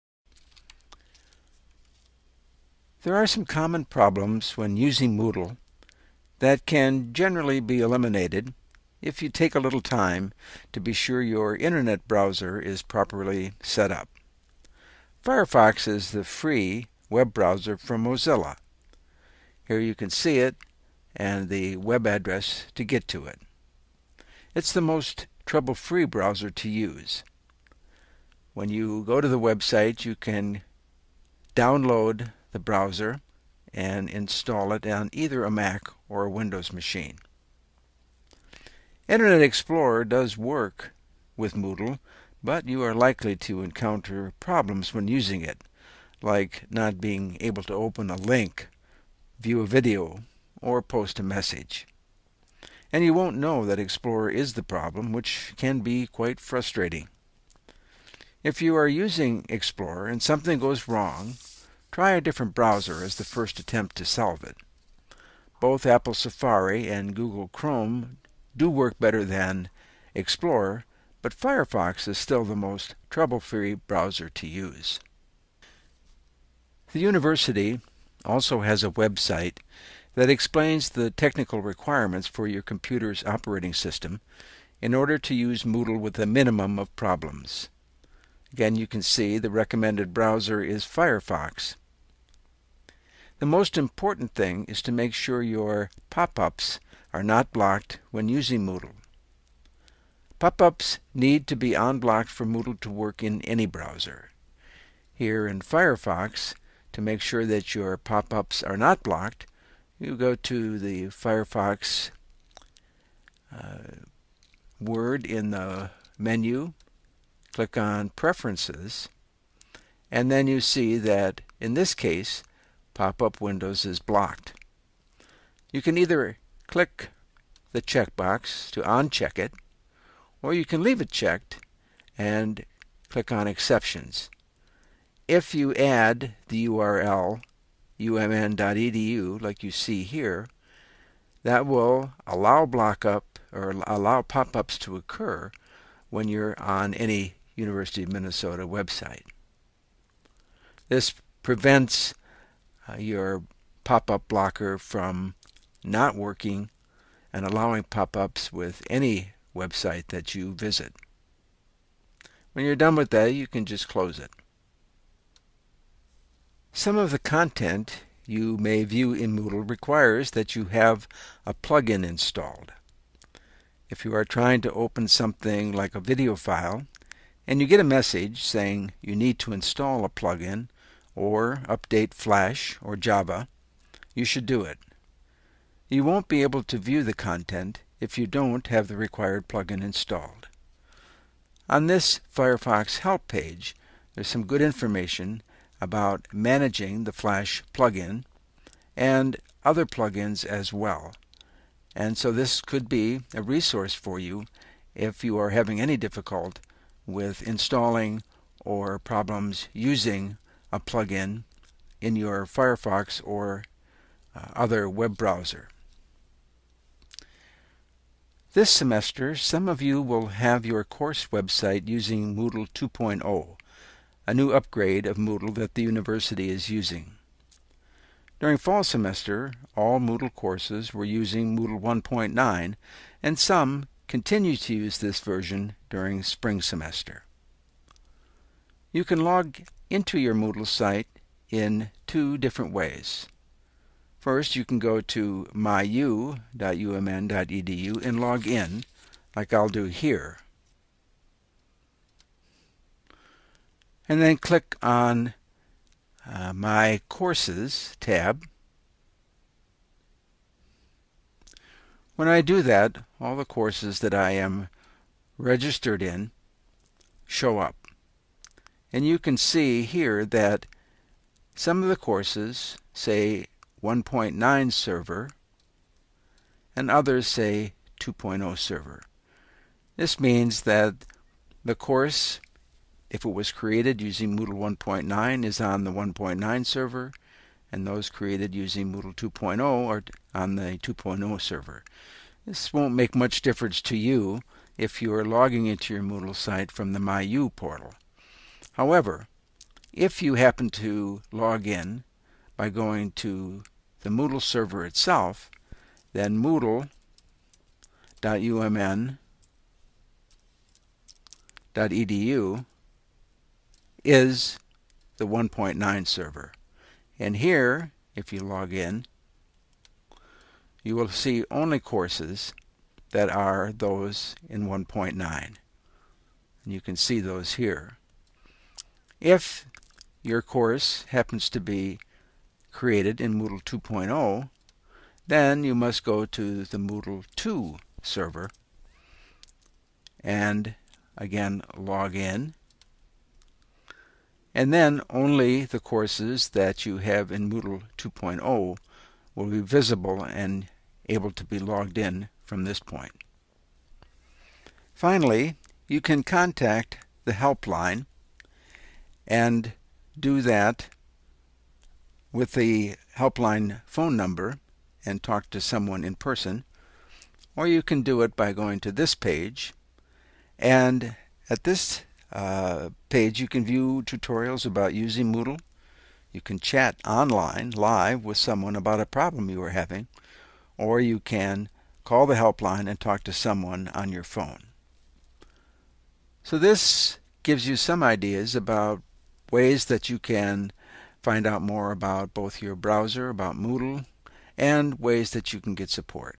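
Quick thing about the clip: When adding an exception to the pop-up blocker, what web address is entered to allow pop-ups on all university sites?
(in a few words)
umn.edu.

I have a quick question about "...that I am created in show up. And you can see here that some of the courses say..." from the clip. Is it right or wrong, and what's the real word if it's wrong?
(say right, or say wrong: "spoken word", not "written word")
wrong: "registered", not "created".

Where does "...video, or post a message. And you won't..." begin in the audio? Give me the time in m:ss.
0:49.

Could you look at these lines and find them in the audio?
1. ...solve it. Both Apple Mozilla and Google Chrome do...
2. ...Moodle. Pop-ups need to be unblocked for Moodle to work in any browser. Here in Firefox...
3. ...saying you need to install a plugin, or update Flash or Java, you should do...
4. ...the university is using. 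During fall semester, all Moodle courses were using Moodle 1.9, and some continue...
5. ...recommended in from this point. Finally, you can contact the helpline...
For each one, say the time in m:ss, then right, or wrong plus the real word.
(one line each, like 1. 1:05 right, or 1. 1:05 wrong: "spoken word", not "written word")
1. 1:04 wrong: "Safari", not "Mozilla"
2. 1:38 right
3. 2:58 right
4. 3:45 right
5. 5:51 wrong: "logged", not "recommended".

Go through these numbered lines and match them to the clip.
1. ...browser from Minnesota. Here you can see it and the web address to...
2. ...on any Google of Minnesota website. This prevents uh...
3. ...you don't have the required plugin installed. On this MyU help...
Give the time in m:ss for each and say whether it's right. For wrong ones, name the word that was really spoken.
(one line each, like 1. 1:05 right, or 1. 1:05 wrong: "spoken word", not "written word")
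1. 0:17 wrong: "Mozilla", not "Minnesota"
2. 2:26 wrong: "University", not "Google"
3. 3:08 wrong: "Firefox", not "MyU".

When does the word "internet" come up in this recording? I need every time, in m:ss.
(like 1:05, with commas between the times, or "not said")
0:11, 0:39.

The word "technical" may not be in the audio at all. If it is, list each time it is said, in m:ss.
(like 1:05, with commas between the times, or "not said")
1:21.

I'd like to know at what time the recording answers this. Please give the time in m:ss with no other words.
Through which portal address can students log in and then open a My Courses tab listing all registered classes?
4:05.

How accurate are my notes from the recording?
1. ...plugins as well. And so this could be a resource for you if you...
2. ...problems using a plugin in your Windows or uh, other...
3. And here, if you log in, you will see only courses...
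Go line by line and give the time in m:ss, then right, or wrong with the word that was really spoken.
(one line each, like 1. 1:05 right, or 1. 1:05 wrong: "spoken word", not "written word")
1. 3:19 right
2. 3:28 wrong: "Firefox", not "Windows"
3. 5:17 right.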